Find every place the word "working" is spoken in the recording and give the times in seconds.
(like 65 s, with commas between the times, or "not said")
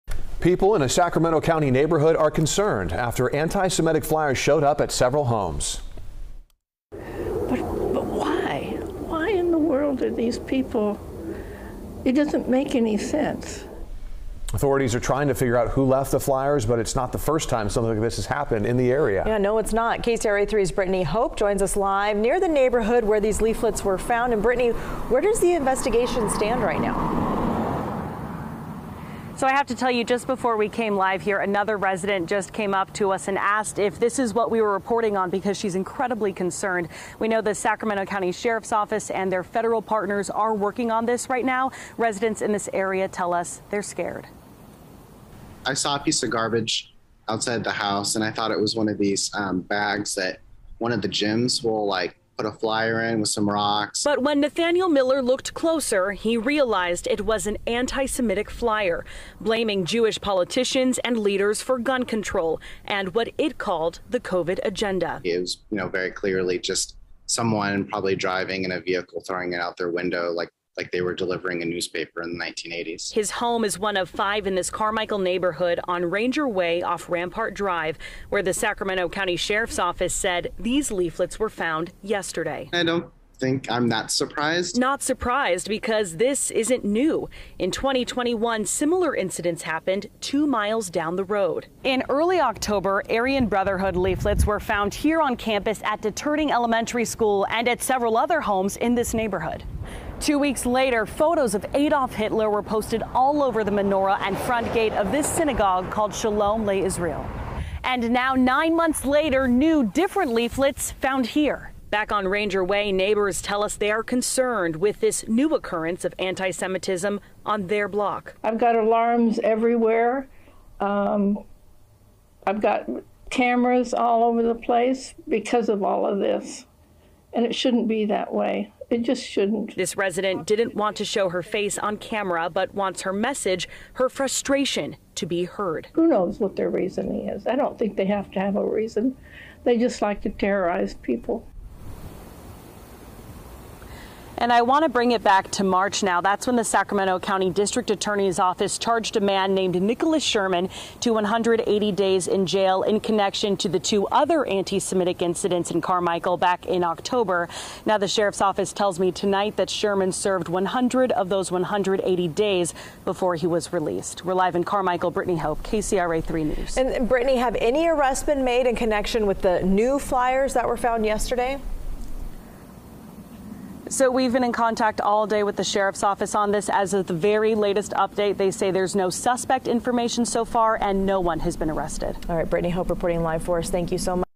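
40 s.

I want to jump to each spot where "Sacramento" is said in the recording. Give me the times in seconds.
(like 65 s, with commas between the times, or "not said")
0 s, 37 s, 78 s, 146 s.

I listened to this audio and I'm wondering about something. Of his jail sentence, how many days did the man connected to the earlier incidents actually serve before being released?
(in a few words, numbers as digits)
100.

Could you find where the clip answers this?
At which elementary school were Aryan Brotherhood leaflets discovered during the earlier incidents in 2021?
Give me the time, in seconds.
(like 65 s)
96 s.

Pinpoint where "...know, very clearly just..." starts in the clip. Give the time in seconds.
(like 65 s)
65 s.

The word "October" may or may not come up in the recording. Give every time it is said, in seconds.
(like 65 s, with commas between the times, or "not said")
92 s, 156 s.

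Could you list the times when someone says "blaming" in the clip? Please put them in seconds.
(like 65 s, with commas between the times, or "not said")
59 s.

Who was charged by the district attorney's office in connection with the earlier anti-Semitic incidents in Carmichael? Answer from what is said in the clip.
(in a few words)
Nicholas Sherman.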